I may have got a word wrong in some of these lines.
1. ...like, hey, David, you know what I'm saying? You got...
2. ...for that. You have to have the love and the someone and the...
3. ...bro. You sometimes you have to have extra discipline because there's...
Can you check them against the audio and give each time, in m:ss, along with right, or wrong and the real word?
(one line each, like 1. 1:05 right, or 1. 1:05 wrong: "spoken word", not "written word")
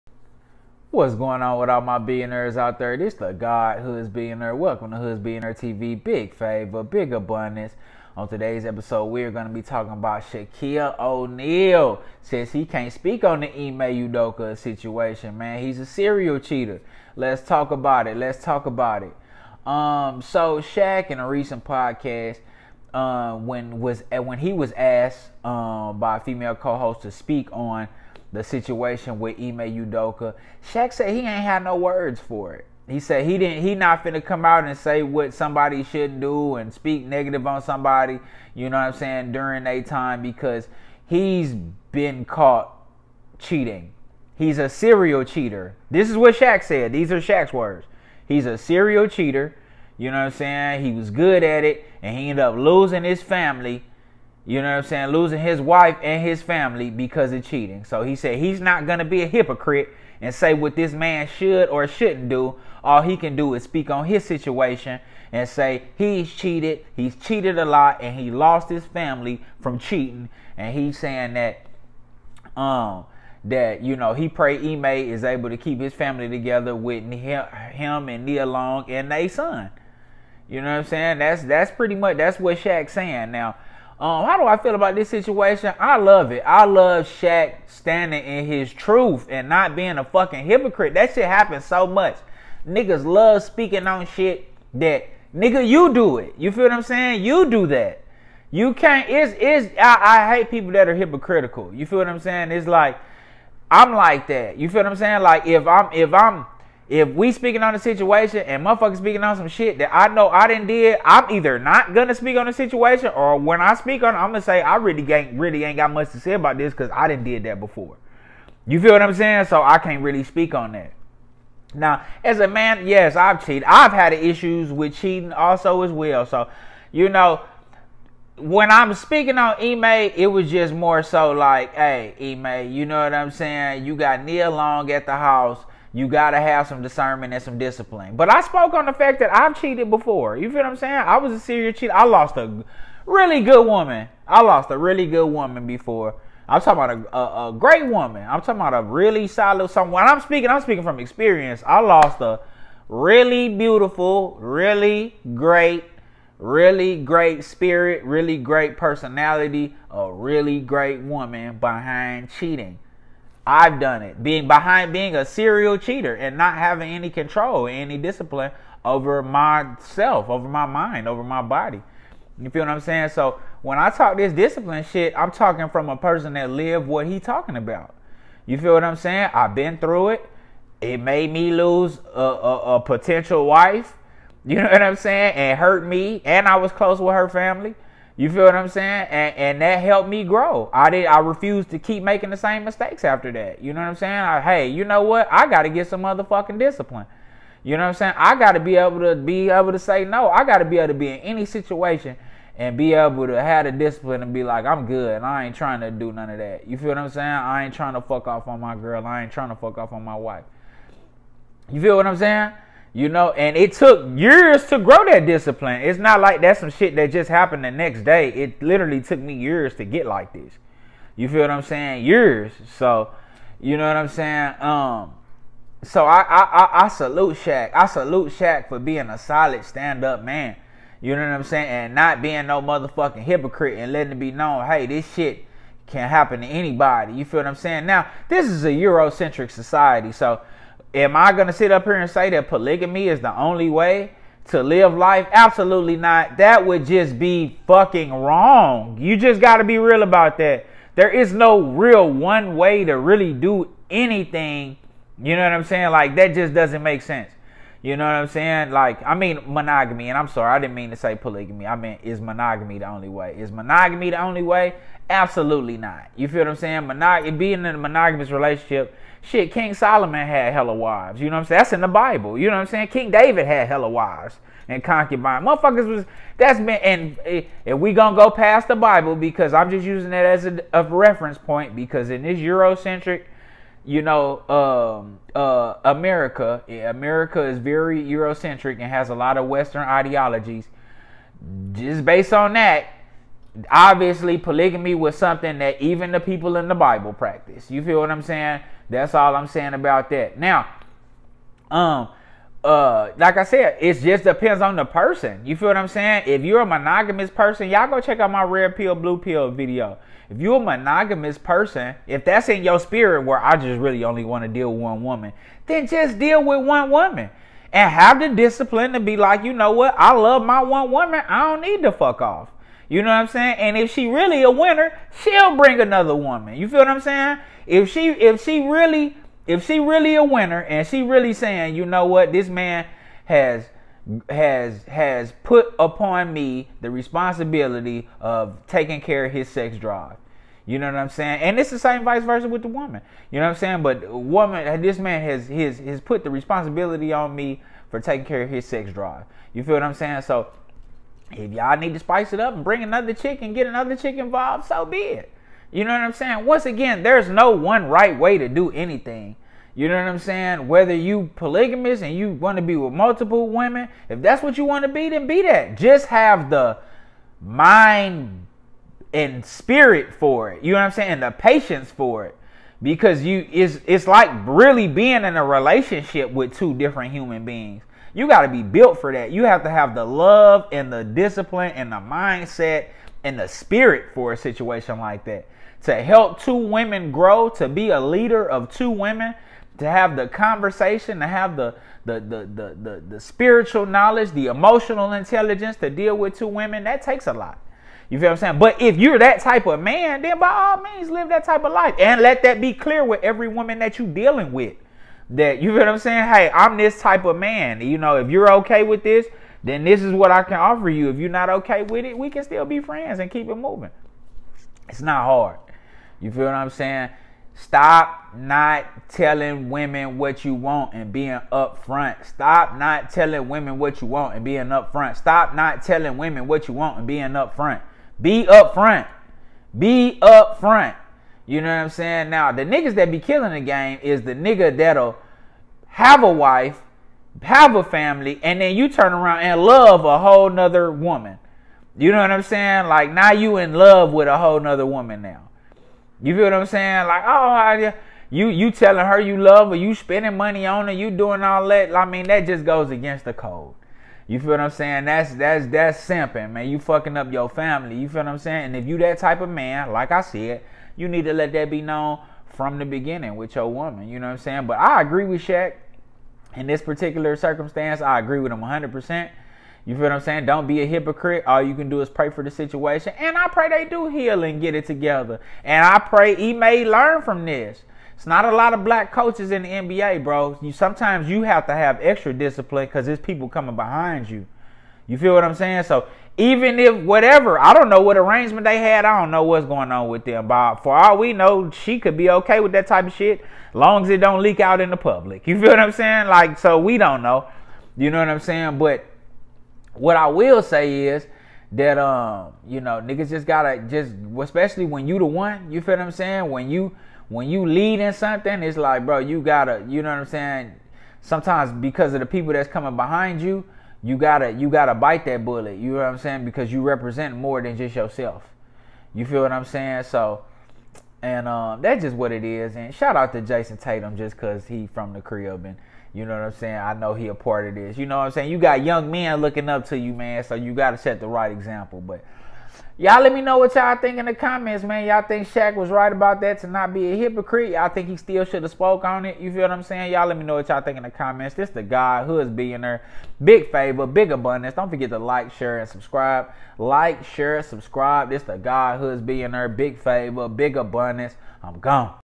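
1. 2:11 wrong: "Ime", not "David"
2. 6:18 wrong: "discipline", not "someone"
3. 8:00 right.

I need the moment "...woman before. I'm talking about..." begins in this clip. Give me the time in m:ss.
2:25.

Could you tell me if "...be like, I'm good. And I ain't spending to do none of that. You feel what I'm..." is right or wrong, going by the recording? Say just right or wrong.
wrong.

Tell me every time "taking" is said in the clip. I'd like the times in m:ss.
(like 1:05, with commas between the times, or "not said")
5:38, 5:47.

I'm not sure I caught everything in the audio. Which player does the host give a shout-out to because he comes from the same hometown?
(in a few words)
Jayson Tatum.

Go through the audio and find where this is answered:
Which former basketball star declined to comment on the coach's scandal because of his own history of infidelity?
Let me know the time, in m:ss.
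0:10.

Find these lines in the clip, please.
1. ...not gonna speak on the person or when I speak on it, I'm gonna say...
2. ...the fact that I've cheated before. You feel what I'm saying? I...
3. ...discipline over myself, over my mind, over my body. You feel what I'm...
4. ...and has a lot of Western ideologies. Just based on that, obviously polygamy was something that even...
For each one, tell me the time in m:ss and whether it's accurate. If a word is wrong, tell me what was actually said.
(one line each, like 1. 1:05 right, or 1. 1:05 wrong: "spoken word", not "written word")
1. 1:51 wrong: "situation", not "person"
2. 2:18 right
3. 2:47 right
4. 4:48 right.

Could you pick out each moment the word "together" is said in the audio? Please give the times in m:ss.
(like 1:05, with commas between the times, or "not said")
1:16, 7:54.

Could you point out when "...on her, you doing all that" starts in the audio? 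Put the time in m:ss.
7:30.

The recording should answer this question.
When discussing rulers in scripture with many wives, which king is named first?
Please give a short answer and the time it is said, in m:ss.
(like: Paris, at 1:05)
King Solomon, at 4:29.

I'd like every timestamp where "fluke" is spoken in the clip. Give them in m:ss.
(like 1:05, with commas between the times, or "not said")
not said.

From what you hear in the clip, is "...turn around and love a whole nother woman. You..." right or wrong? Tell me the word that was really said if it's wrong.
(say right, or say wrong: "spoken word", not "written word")
right.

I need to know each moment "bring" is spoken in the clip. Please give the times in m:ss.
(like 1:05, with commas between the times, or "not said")
5:25, 5:52.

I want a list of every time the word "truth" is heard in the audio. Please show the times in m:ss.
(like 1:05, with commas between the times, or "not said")
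1:28.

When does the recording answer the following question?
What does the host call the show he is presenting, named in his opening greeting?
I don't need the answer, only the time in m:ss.
0:04.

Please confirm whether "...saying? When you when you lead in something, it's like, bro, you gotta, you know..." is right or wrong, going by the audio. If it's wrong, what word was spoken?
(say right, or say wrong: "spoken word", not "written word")
right.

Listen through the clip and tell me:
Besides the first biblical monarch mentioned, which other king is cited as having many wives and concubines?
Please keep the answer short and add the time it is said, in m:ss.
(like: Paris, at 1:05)
King David, at 4:32.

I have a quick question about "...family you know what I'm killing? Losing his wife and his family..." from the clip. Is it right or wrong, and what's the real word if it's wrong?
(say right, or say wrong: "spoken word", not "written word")
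wrong: "saying", not "killing".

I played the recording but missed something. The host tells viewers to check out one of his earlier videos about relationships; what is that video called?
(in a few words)
red pill, blue pill.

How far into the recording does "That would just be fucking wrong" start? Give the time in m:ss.
4:06.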